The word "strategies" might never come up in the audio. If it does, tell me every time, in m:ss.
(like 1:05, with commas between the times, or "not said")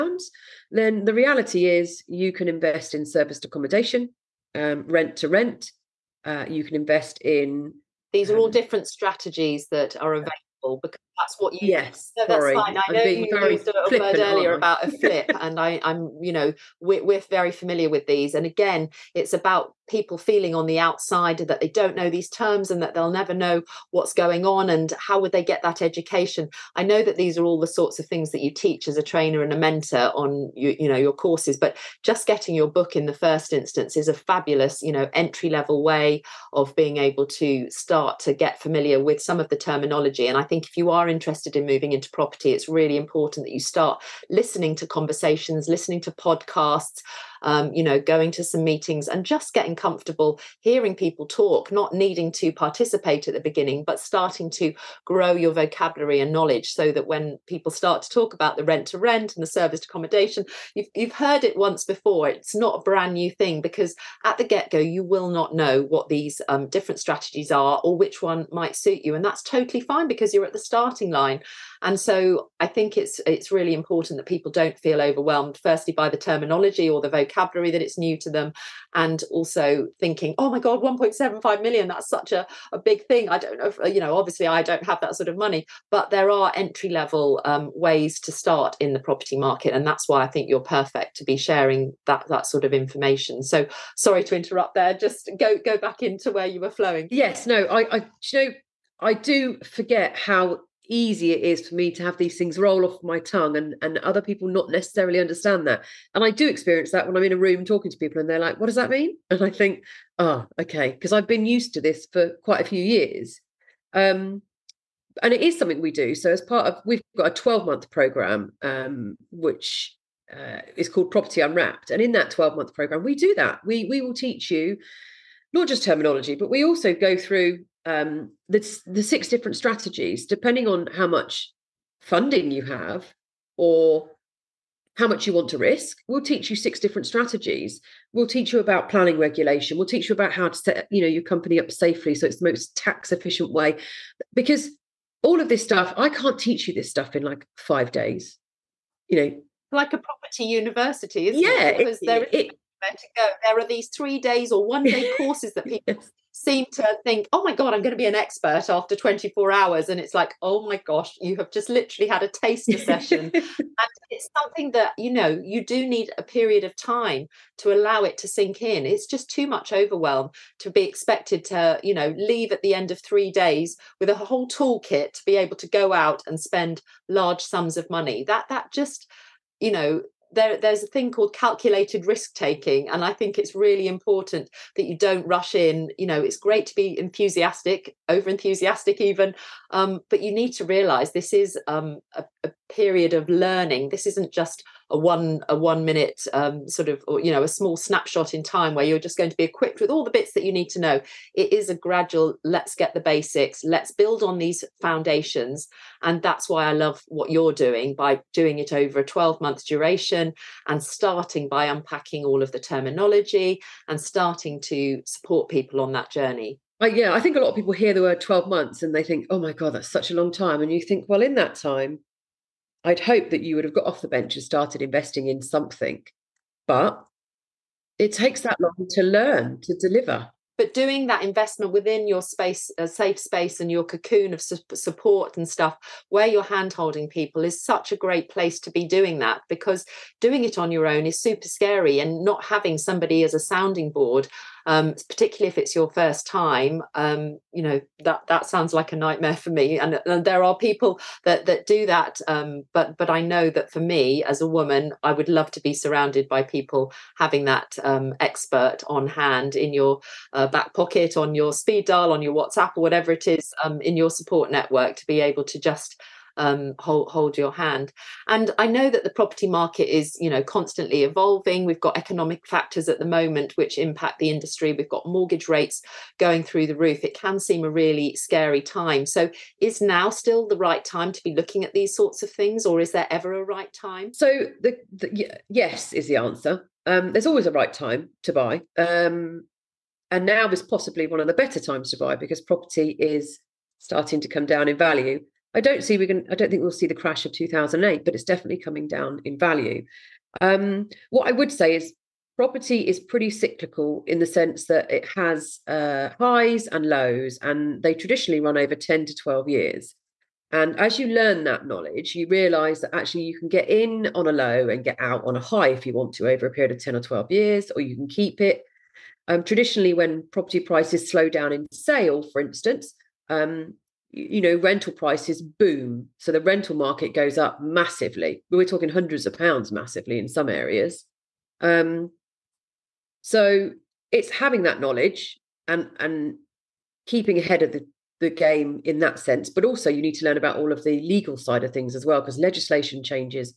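0:08, 1:06, 2:09, 2:17.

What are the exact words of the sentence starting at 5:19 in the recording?
Um, traditionally, when property prices slow down in sale, for instance, um, you know, rental prices boom.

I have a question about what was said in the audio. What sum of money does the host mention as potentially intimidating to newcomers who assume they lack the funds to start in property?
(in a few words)
1.75 million.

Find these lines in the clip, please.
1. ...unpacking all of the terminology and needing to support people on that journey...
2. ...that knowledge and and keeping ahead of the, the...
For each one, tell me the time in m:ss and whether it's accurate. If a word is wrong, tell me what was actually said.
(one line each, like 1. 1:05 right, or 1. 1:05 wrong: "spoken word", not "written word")
1. 3:31 wrong: "starting", not "needing"
2. 5:34 right.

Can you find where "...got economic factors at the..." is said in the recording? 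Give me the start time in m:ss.
4:31.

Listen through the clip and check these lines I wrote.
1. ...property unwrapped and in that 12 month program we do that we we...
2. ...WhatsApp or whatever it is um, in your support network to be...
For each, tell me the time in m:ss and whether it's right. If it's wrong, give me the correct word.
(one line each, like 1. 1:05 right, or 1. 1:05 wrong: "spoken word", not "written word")
1. 2:01 right
2. 4:22 right.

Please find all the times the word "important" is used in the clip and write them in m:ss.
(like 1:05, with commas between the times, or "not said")
0:42, 1:13, 3:03.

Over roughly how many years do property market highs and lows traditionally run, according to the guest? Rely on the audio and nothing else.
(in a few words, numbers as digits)
10 to 12 years.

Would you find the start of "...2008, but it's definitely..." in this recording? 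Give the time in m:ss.
4:57.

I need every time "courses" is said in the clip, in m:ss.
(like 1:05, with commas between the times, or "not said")
0:31, 2:35.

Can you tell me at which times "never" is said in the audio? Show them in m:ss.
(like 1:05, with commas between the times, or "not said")
0:23.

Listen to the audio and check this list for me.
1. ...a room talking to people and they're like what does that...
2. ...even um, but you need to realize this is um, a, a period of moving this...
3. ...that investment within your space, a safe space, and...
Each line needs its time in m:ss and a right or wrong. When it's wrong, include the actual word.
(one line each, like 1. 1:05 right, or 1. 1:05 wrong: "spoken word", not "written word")
1. 1:47 right
2. 3:09 wrong: "learning", not "moving"
3. 3:51 right.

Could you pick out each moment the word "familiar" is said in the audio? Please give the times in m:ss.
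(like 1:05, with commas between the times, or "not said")
0:17, 0:38.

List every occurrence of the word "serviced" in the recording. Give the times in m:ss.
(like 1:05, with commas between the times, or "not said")
0:03, 0:59.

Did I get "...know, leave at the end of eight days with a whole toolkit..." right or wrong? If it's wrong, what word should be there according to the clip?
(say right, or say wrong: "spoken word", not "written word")
wrong: "three", not "eight".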